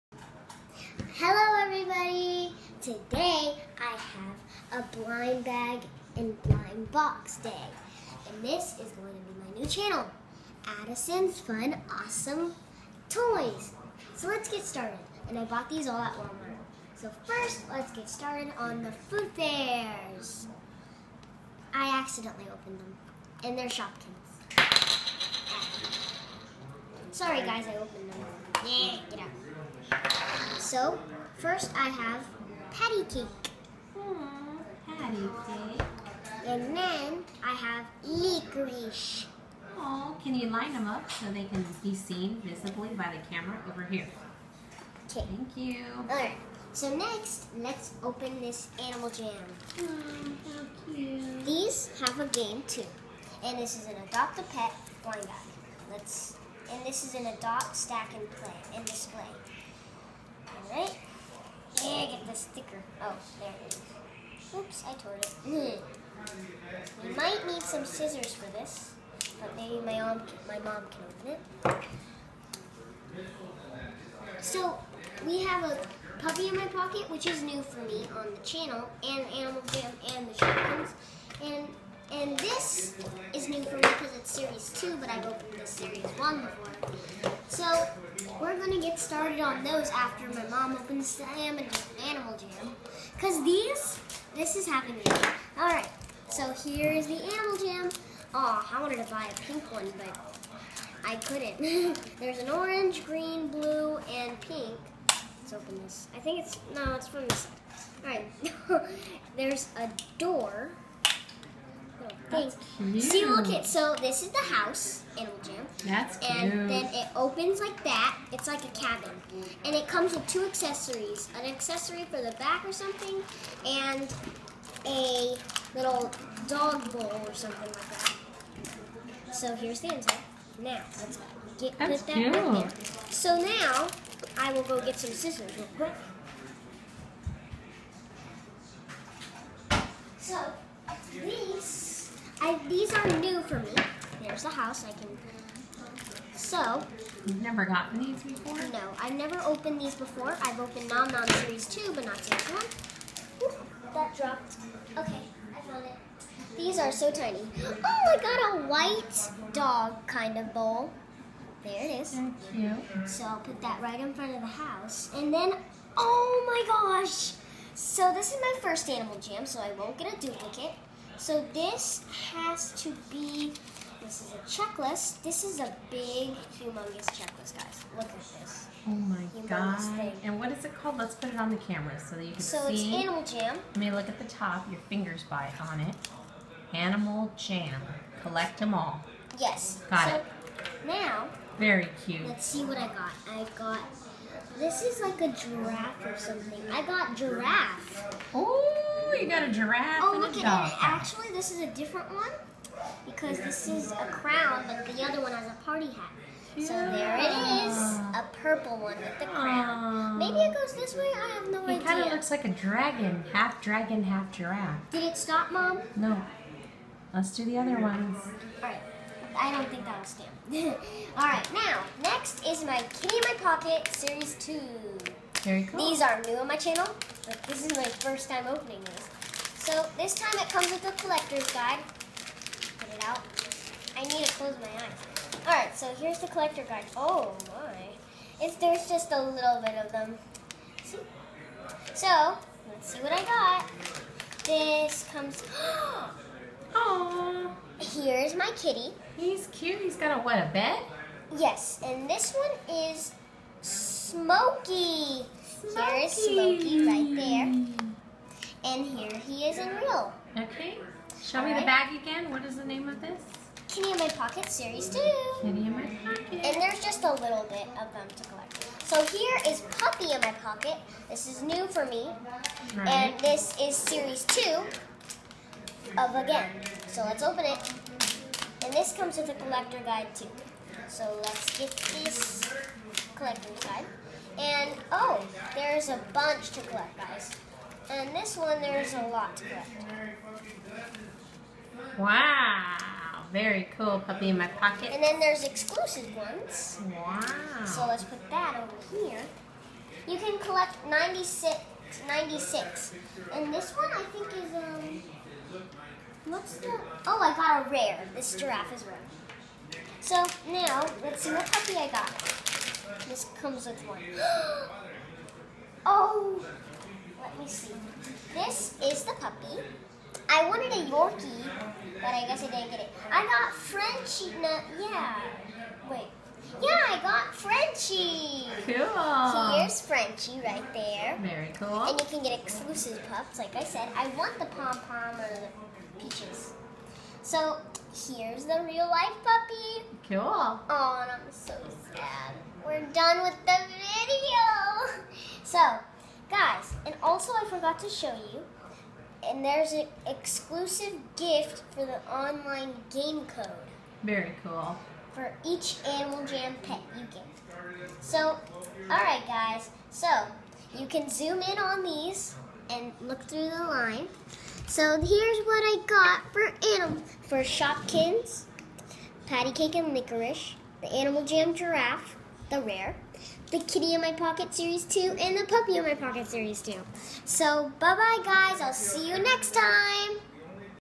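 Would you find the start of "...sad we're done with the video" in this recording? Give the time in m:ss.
5:41.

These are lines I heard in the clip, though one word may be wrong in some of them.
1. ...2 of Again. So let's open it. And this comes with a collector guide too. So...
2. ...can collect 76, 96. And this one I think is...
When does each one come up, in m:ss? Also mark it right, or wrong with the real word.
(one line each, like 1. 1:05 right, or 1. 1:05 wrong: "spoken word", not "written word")
1. 4:34 right
2. 5:00 wrong: "96", not "76".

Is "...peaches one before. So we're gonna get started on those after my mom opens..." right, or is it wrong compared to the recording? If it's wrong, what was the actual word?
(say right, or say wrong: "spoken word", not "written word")
wrong: "series", not "peaches".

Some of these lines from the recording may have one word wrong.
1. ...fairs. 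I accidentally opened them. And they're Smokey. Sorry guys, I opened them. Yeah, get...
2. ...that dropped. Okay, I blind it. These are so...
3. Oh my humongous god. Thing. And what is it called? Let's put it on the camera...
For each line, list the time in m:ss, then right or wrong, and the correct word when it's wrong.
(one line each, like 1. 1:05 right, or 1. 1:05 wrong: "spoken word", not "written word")
1. 0:19 wrong: "Shopkins", not "Smokey"
2. 2:33 wrong: "found", not "blind"
3. 2:58 right.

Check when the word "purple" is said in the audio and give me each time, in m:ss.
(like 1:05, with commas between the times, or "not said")
3:28.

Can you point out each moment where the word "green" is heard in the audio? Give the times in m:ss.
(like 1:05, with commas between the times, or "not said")
1:43.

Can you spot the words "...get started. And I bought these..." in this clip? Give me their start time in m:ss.
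0:14.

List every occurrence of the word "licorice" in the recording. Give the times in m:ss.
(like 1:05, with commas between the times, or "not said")
0:38, 6:09.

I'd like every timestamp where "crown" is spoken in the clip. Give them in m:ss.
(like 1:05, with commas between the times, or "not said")
3:24, 3:29.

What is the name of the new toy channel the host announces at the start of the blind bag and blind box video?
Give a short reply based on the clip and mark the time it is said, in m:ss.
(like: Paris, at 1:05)
Addison's Fun Awesome Toys, at 0:10.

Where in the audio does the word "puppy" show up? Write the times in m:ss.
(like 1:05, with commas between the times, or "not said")
1:16, 4:29, 4:54, 5:11, 5:19, 5:39, 6:15.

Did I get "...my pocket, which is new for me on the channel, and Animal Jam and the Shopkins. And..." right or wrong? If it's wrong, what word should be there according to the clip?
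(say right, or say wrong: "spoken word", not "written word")
right.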